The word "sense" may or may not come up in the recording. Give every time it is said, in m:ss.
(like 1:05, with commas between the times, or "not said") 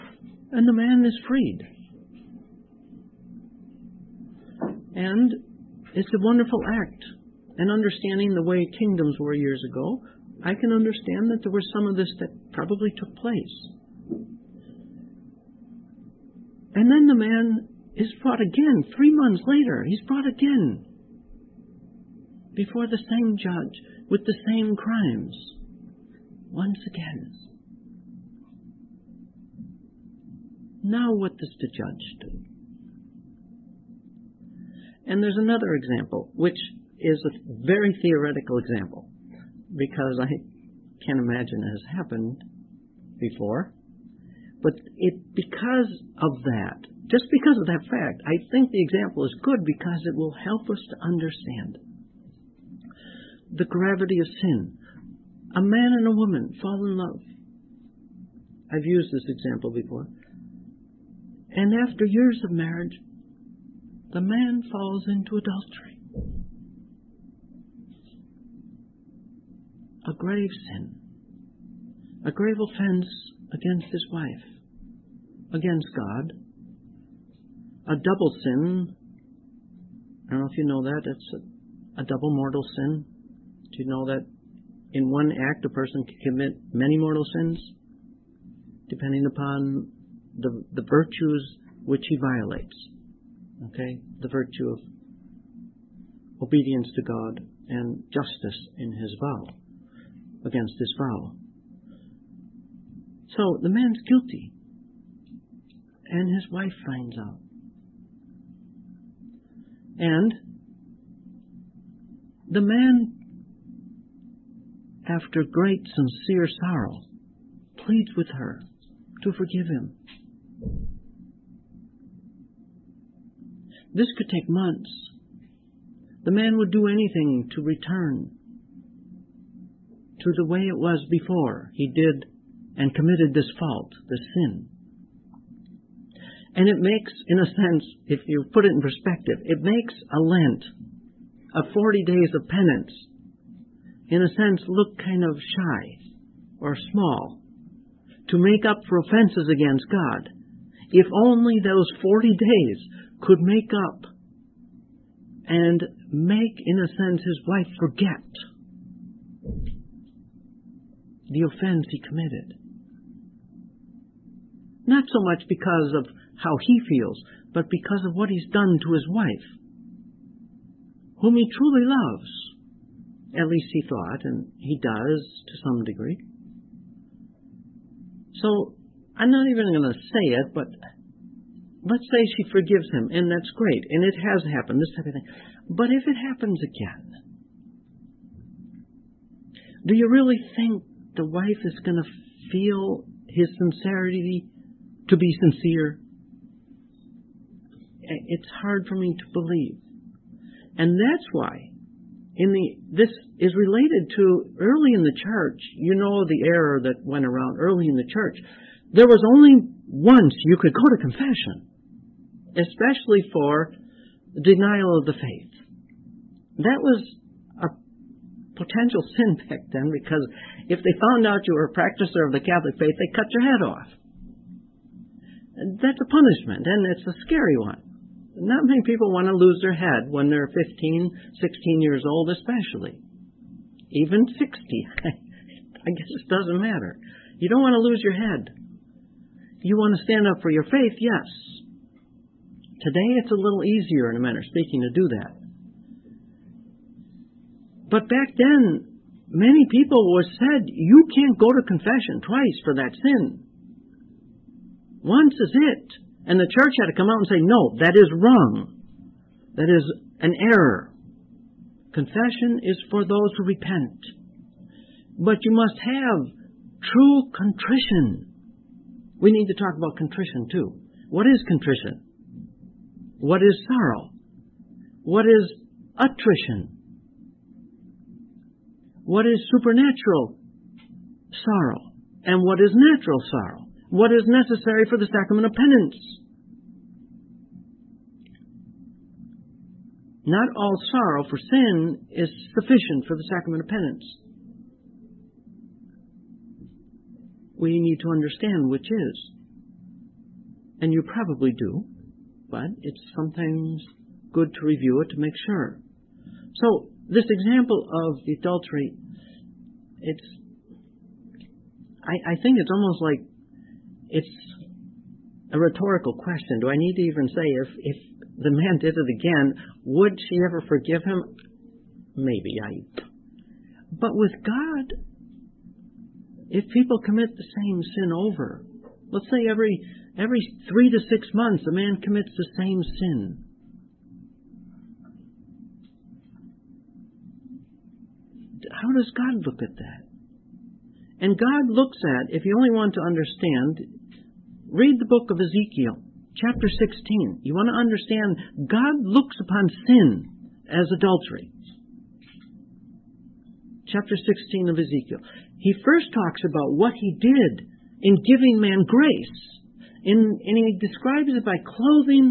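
2:17, 2:24, 2:36.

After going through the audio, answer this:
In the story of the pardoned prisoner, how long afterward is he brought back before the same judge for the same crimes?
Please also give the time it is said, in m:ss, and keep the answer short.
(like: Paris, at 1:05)
3 months, at 0:18.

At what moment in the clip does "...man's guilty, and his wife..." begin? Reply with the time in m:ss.
1:43.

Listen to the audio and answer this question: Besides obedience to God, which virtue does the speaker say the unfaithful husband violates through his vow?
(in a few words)
justice.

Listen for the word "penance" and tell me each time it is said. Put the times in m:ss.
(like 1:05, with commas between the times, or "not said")
2:22, 4:45, 4:53.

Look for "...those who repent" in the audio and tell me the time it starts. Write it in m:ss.
4:23.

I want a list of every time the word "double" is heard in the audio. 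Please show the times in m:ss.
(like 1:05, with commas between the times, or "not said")
1:17, 1:22.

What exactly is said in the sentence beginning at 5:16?
Do I need to even say if if the man did it again, would she ever forgive him?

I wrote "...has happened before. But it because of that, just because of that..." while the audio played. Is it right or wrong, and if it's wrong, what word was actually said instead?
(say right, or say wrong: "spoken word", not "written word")
right.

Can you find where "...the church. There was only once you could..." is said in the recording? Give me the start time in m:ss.
3:27.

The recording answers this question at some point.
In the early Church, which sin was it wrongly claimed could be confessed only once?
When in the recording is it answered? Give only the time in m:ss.
3:34.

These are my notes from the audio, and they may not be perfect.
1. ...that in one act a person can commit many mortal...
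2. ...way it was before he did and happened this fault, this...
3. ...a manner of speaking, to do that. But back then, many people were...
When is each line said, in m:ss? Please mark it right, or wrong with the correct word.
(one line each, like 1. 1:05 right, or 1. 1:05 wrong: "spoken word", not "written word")
1. 1:24 right
2. 2:10 wrong: "committed", not "happened"
3. 4:04 right.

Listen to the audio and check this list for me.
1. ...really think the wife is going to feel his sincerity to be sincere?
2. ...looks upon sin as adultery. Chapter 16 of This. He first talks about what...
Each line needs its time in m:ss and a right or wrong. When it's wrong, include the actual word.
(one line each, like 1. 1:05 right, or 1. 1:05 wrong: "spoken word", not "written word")
1. 3:10 right
2. 5:49 wrong: "Ezekiel", not "This".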